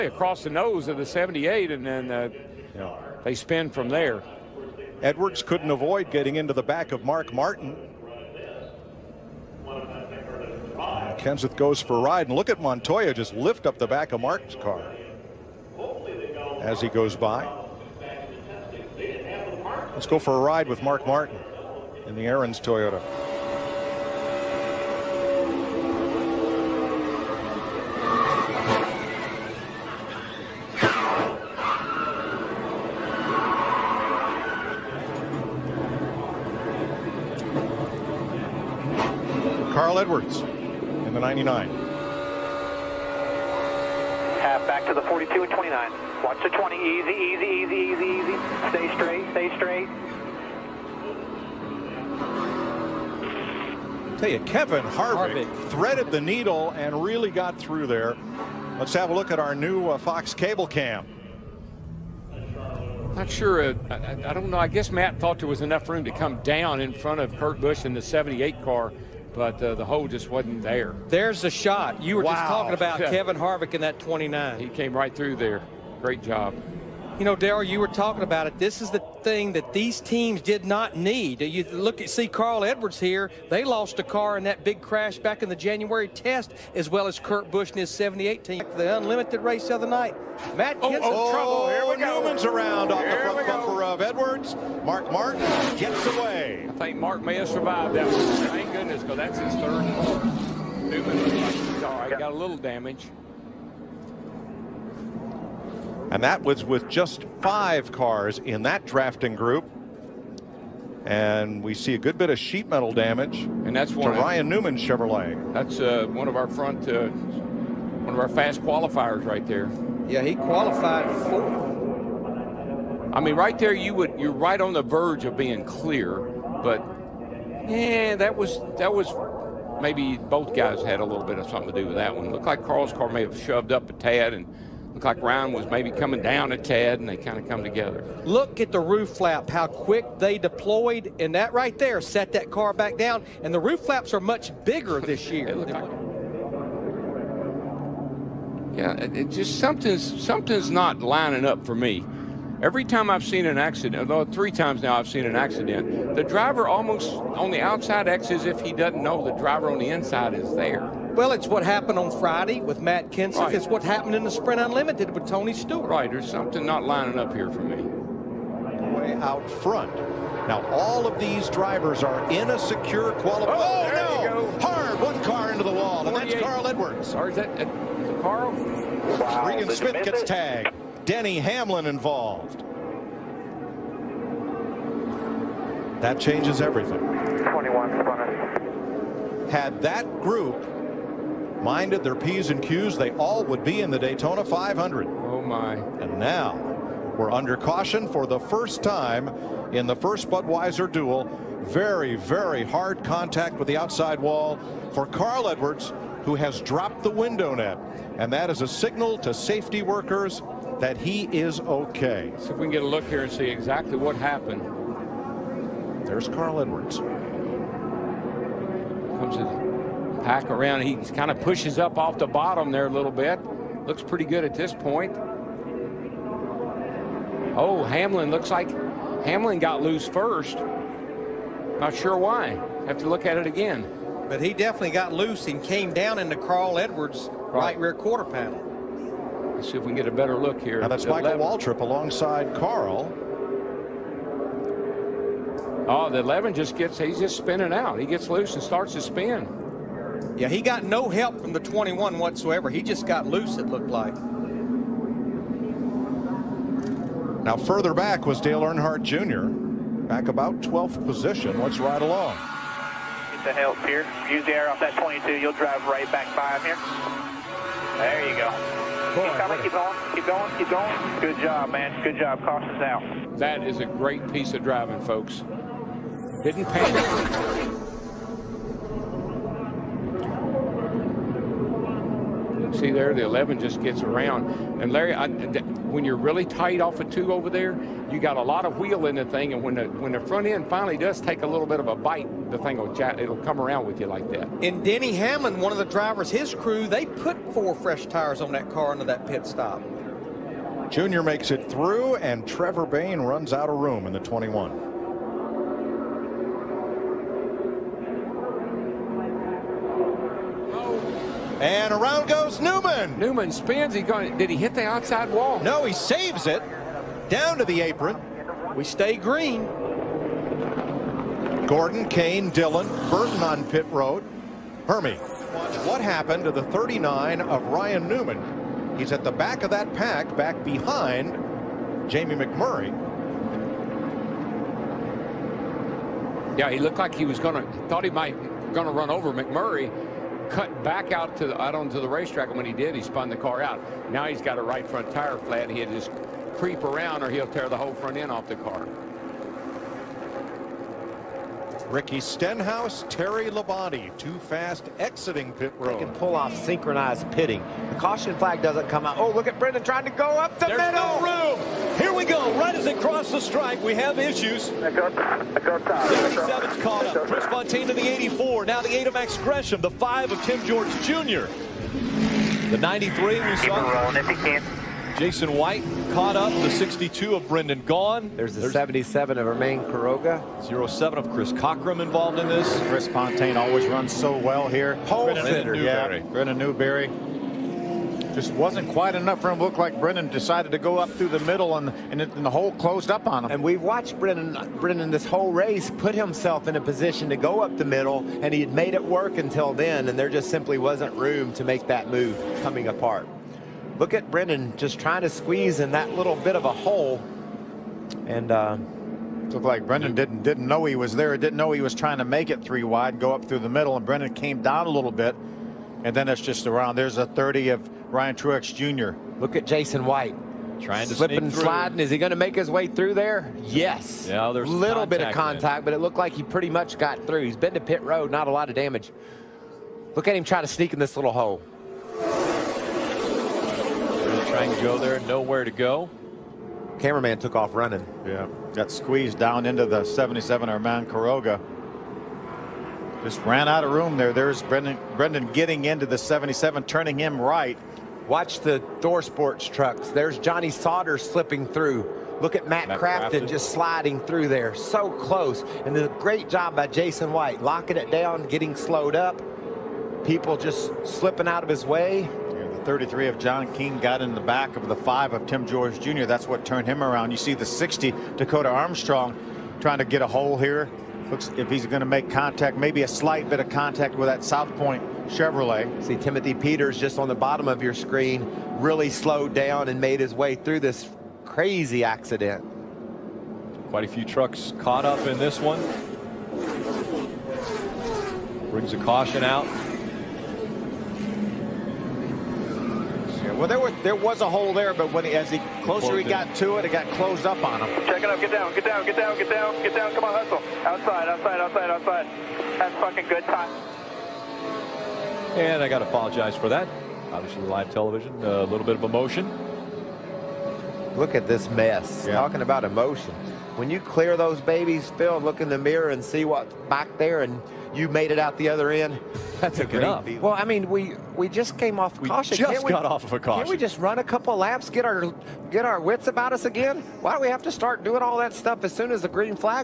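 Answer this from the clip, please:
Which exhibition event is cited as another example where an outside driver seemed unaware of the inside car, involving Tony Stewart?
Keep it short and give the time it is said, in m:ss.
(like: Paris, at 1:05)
Sprint Unlimited, at 2:44.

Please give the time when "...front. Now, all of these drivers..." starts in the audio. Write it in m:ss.
2:49.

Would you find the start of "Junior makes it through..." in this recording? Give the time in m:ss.
5:00.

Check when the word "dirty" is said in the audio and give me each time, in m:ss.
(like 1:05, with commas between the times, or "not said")
not said.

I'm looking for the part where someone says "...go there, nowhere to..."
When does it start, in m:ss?
7:14.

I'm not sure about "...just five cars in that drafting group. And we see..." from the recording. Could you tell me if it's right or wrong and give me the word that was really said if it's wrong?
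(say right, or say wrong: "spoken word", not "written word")
right.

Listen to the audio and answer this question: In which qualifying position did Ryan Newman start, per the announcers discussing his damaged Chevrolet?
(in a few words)
Fourth.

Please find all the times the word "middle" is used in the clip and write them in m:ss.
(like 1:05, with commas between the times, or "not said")
6:00, 6:31, 6:37, 6:53.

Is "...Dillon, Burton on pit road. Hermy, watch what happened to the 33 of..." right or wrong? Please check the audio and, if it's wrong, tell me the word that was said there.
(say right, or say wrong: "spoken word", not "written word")
wrong: "39", not "33".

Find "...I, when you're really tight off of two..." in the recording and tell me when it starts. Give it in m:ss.
4:45.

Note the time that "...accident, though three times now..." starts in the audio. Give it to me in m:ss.
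2:33.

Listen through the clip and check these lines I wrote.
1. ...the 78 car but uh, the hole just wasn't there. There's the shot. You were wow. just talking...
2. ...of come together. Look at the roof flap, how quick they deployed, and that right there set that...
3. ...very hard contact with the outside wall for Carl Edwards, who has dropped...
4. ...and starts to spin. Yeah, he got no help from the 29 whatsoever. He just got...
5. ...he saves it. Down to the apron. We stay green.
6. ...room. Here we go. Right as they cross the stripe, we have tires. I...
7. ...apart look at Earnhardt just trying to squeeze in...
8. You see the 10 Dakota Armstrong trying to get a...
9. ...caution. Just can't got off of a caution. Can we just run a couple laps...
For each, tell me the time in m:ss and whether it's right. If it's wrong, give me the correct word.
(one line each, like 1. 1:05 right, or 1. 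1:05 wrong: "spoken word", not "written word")
1. 1:07 right
2. 2:17 right
3. 3:22 right
4. 4:08 wrong: "21", not "29"
5. 5:15 right
6. 6:01 wrong: "issues", not "tires"
7. 6:42 wrong: "Brendan", not "Earnhardt"
8. 7:47 wrong: "60", not "10"
9. 8:42 right.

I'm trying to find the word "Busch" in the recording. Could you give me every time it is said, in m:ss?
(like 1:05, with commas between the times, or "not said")
1:07, 1:27.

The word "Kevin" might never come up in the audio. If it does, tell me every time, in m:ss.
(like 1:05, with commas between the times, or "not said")
0:54, 1:12.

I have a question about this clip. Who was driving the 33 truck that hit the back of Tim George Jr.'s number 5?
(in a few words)
John King.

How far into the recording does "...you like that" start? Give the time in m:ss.
4:53.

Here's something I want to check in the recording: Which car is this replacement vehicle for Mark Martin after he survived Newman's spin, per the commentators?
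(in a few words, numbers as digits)
third car.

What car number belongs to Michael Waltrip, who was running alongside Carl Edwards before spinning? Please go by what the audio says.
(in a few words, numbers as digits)
11.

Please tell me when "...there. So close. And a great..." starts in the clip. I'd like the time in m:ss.
7:34.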